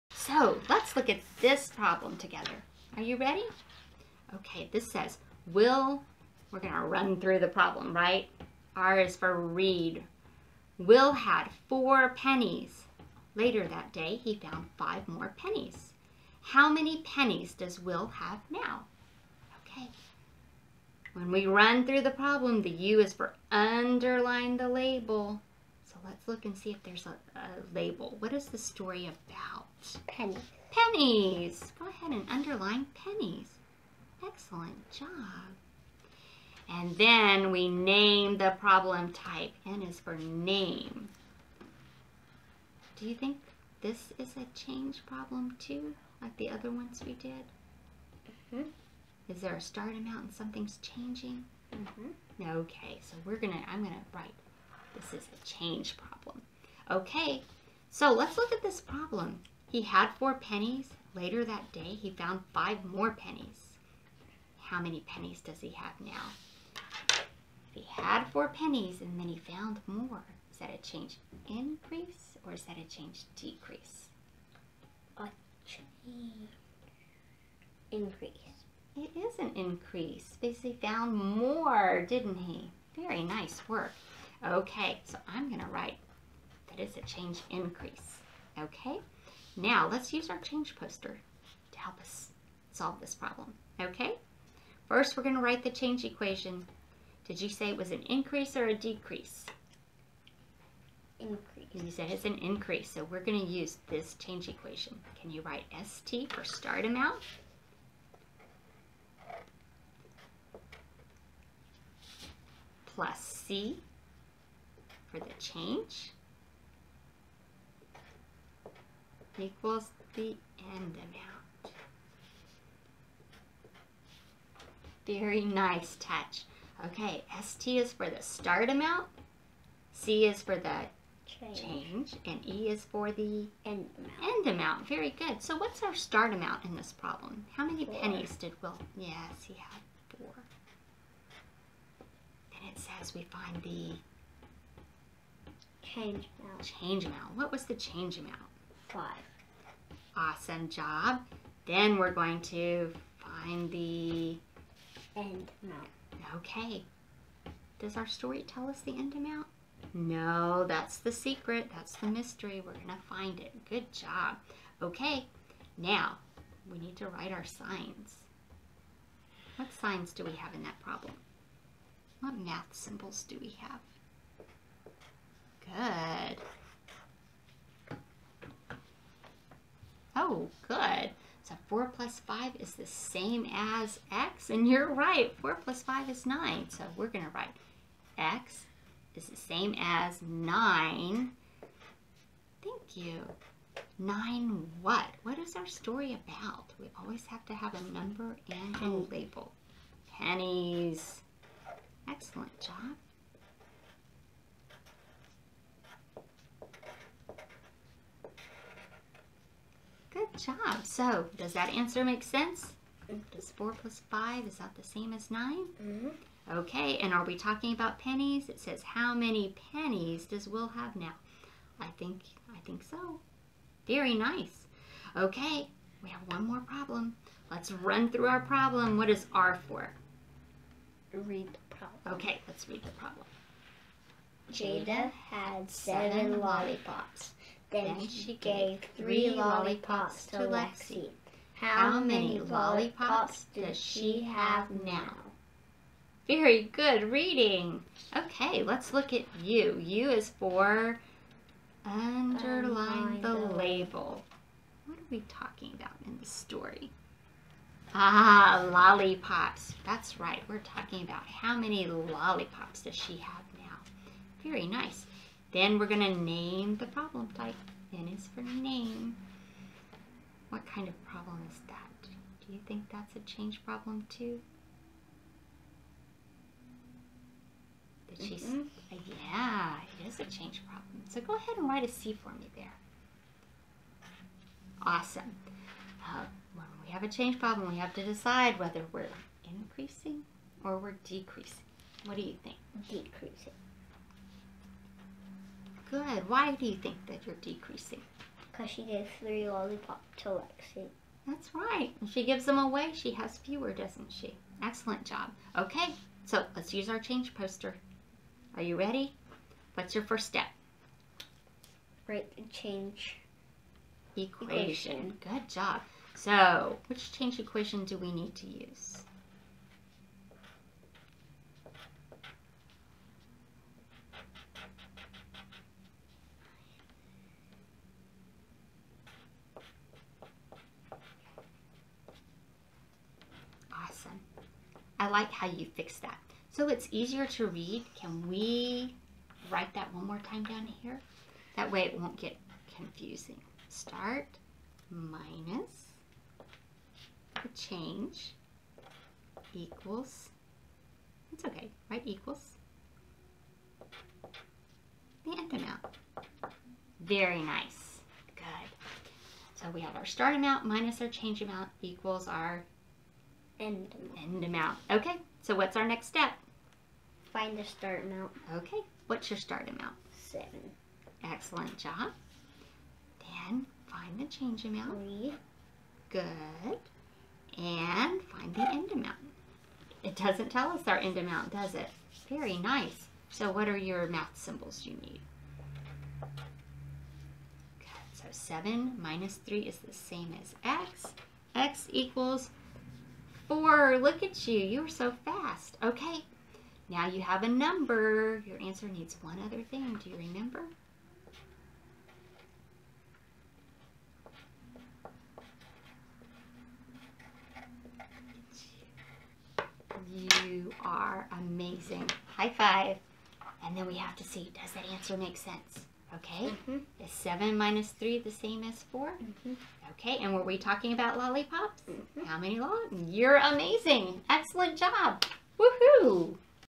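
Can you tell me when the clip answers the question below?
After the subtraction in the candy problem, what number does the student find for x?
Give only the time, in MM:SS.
06:31.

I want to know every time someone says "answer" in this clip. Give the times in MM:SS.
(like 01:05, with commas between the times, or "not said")
03:31, 06:38, 06:54.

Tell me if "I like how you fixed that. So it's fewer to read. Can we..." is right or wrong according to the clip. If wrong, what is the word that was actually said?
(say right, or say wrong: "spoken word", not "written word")
wrong: "easier", not "fewer".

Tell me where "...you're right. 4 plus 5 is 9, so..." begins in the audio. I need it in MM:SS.
03:04.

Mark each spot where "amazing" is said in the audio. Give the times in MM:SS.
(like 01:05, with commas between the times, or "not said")
06:51, 07:03.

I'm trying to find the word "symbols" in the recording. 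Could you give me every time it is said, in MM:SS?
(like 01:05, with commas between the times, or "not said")
02:52, 06:24.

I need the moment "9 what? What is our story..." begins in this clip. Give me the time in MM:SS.
03:13.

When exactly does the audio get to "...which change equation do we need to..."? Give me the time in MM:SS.
05:16.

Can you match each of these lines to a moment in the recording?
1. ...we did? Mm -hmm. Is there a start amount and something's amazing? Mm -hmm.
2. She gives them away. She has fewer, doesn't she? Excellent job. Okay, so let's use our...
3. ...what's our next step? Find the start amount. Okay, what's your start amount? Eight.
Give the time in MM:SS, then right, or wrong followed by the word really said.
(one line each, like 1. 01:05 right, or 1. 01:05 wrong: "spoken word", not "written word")
1. 00:47 wrong: "changing", not "amazing"
2. 05:02 right
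3. 06:05 wrong: "Seven", not "Eight".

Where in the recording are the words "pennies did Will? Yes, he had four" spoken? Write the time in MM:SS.
02:17.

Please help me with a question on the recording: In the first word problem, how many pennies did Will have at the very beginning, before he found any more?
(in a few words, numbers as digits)
4.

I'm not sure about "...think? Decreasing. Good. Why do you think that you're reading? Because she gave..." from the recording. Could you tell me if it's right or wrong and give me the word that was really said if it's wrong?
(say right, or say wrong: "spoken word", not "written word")
wrong: "decreasing", not "reading".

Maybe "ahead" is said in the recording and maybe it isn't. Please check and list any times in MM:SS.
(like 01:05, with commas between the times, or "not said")
00:31, 04:41.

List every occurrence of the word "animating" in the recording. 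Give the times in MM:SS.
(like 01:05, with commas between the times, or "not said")
not said.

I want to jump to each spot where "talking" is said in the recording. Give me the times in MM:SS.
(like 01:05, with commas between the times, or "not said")
03:37, 04:15, 04:20, 07:00.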